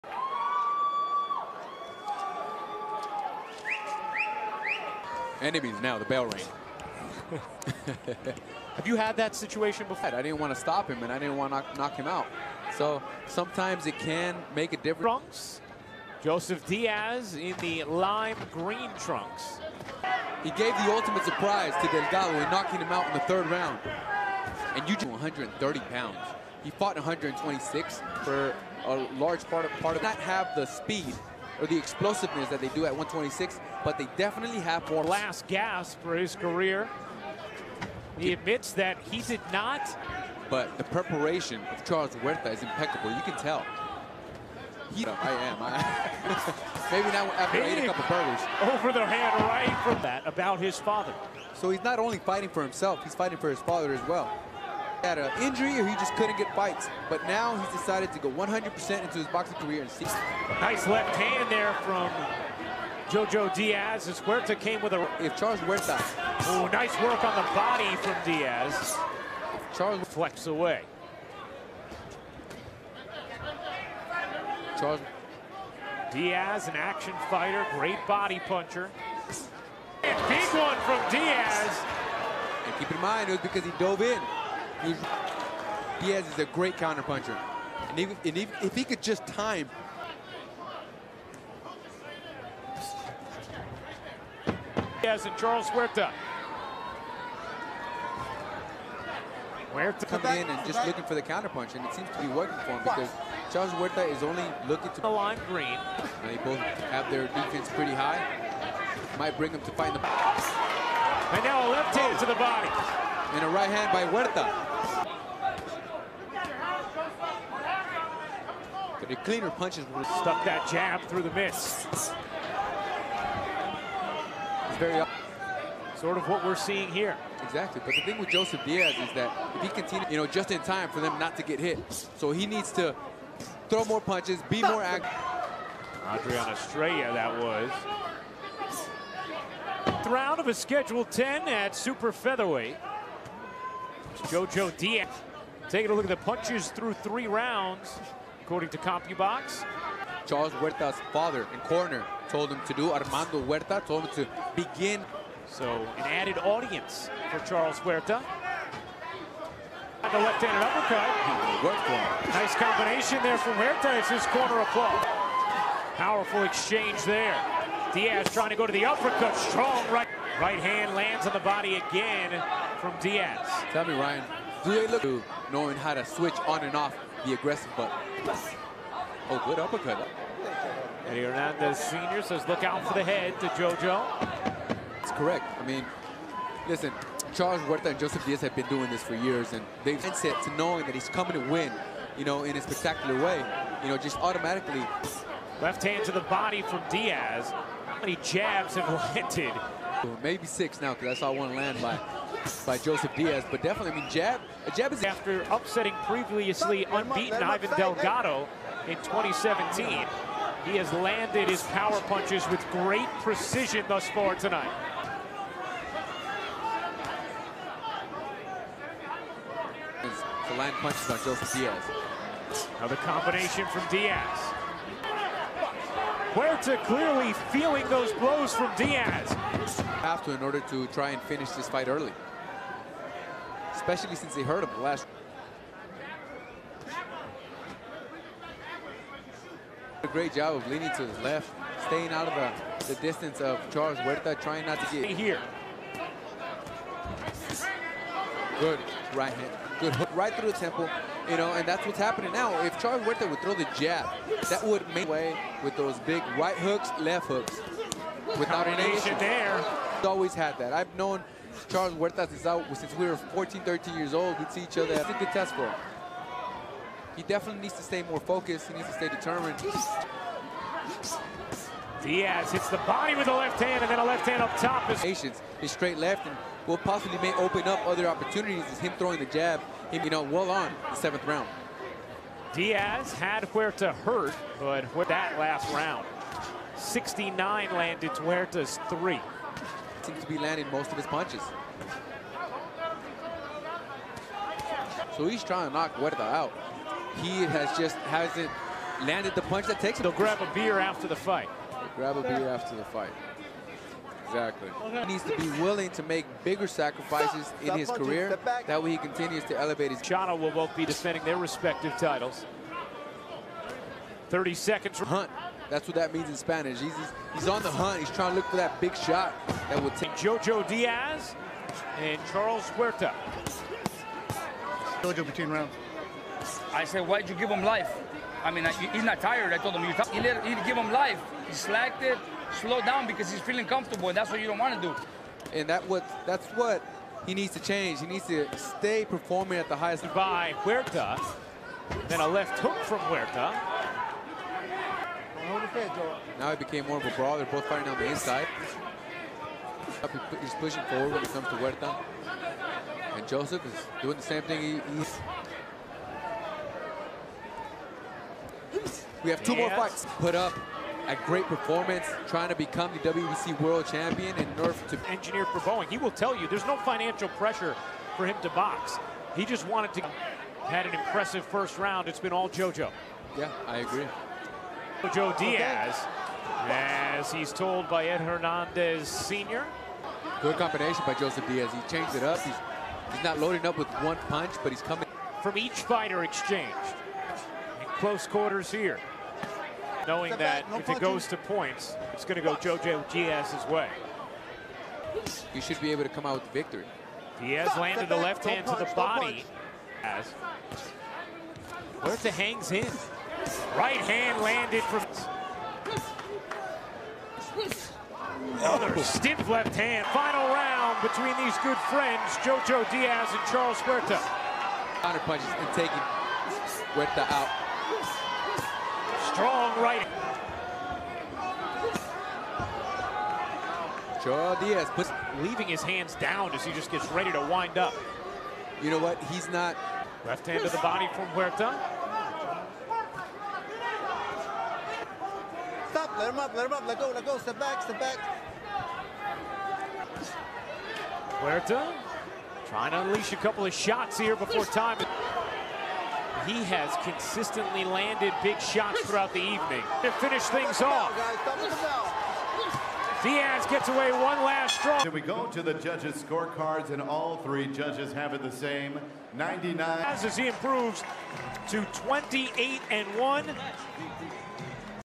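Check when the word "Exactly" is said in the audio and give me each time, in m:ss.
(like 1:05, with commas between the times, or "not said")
2:07, 5:04.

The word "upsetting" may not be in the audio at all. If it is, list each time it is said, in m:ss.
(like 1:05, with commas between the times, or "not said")
3:25.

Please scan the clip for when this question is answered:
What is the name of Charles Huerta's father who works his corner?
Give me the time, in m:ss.
2:32.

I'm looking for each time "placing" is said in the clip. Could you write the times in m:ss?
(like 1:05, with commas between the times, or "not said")
not said.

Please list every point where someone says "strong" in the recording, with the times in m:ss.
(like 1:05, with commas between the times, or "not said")
2:49, 6:59.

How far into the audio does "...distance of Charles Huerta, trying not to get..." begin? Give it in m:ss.
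4:03.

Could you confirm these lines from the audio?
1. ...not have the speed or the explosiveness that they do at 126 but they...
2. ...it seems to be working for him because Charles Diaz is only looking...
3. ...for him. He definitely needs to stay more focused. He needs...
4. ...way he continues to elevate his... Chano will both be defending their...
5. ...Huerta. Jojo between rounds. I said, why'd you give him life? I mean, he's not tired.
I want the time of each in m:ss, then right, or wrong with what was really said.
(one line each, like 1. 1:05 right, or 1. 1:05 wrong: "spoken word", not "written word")
1. 0:30 right
2. 1:41 wrong: "Huerta", not "Diaz"
3. 4:25 right
4. 5:08 right
5. 5:22 right.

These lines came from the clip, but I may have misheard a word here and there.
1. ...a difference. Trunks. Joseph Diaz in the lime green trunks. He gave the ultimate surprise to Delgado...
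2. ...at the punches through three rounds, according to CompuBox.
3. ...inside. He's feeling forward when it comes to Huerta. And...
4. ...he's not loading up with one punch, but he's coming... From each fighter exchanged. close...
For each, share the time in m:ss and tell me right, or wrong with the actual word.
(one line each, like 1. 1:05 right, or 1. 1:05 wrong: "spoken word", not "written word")
1. 0:14 right
2. 2:26 right
3. 5:48 wrong: "pushing", not "feeling"
4. 6:23 right.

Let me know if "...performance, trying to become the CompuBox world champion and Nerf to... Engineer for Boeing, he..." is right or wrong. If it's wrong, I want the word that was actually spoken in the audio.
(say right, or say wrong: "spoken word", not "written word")
wrong: "WBC", not "CompuBox".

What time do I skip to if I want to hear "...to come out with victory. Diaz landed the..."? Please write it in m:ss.
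6:36.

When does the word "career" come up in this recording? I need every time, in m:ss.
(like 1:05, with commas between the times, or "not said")
0:36, 0:59, 5:07.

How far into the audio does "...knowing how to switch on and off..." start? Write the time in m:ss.
2:55.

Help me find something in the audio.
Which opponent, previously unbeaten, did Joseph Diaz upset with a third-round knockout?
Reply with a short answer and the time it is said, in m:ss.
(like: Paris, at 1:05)
Ivan Delgado, at 3:27.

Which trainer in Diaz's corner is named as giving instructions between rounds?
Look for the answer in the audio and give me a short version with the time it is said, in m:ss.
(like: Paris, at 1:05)
Eddie Hernandez Sr., at 3:01.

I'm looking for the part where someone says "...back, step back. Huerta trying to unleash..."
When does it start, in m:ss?
7:17.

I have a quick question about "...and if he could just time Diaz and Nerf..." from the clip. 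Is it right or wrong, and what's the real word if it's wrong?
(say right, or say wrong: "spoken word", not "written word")
wrong: "Charles", not "Nerf".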